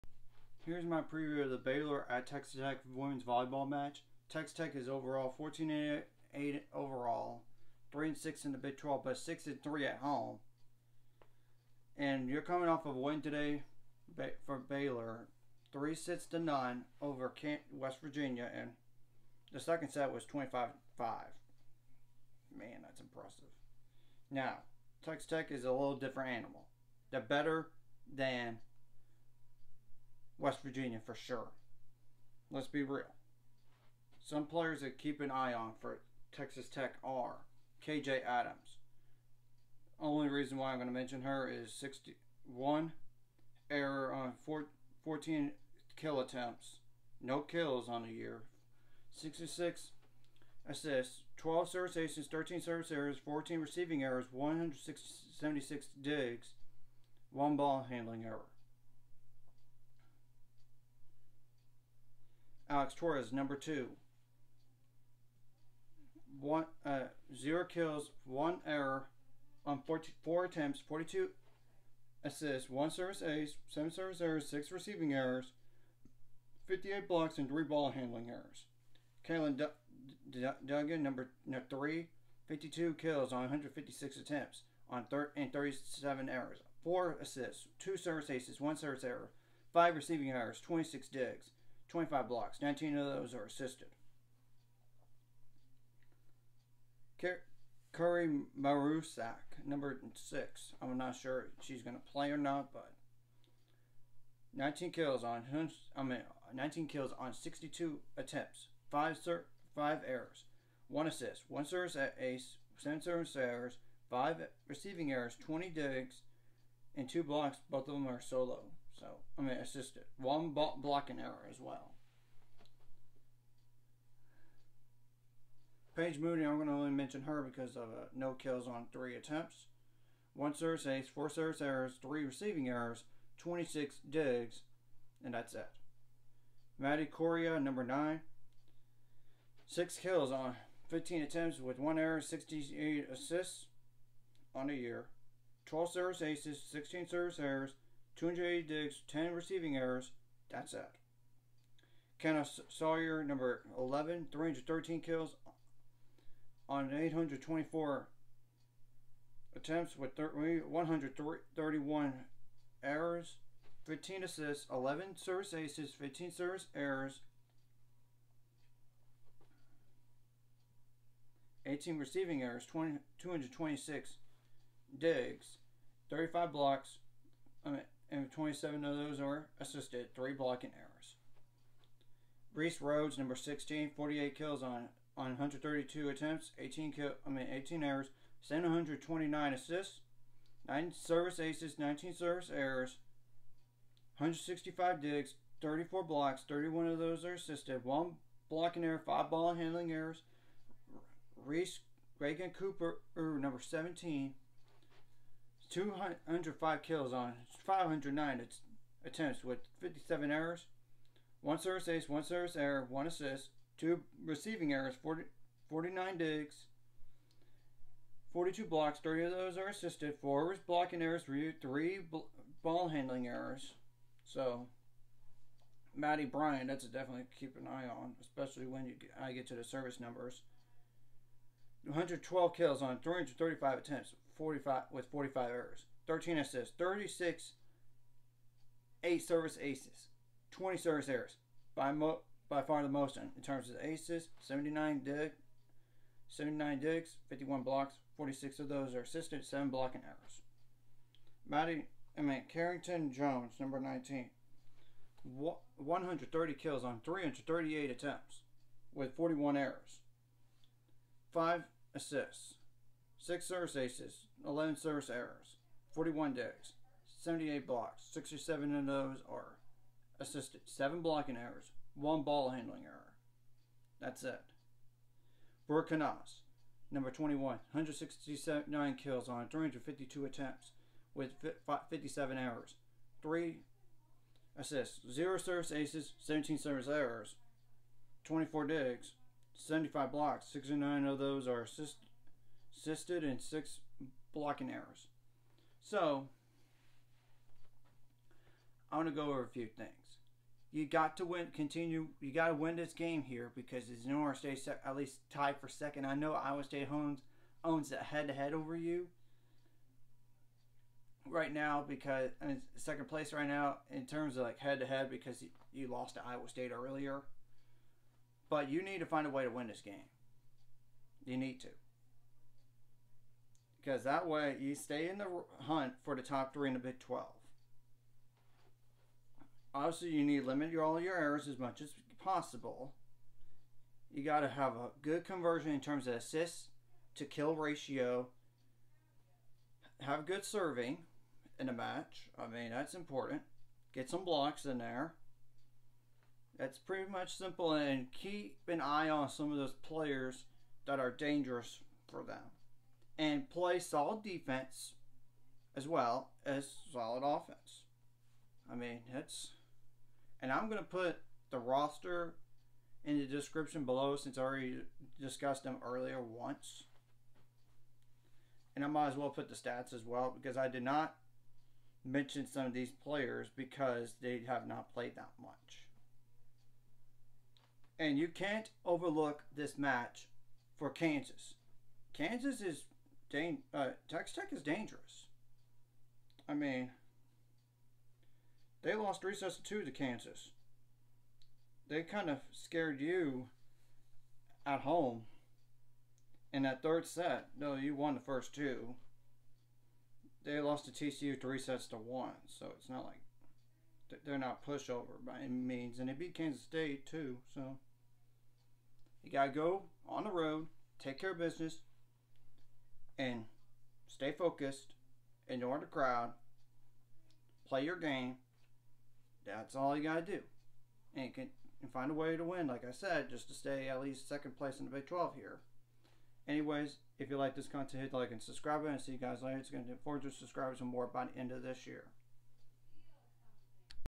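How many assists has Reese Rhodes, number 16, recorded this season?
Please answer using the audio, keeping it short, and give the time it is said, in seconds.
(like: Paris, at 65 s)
729, at 188 s.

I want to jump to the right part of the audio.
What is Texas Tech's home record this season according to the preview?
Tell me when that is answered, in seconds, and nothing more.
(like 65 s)
9 s.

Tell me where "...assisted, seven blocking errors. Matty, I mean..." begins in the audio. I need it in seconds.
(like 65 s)
249 s.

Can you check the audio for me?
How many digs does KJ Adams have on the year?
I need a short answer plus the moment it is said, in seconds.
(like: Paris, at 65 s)
176, at 54 s.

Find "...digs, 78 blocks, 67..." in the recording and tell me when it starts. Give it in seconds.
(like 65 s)
266 s.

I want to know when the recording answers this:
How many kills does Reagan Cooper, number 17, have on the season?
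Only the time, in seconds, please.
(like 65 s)
205 s.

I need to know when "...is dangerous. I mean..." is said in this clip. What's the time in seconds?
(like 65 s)
384 s.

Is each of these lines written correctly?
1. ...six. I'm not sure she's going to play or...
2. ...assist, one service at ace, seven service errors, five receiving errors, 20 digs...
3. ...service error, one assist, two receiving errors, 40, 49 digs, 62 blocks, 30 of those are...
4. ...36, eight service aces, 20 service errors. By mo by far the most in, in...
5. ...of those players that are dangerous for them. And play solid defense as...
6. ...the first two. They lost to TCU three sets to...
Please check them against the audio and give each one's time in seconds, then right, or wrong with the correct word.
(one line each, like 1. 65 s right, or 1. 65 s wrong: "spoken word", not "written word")
1. 100 s right
2. 111 s right
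3. 212 s wrong: "42", not "62"
4. 236 s right
5. 349 s right
6. 398 s right.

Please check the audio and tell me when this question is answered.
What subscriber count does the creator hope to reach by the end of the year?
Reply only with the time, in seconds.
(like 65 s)
430 s.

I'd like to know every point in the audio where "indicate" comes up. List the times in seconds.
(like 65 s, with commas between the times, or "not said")
not said.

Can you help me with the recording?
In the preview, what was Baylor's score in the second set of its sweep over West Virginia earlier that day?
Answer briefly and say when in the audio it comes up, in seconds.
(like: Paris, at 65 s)
25-5, at 20 s.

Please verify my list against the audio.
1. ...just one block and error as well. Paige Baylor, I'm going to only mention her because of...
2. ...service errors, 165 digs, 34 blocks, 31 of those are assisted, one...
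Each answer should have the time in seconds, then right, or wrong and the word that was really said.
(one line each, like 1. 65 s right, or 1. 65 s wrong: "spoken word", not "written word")
1. 119 s wrong: "Moody", not "Baylor"
2. 192 s right.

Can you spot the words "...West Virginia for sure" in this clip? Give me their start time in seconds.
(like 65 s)
30 s.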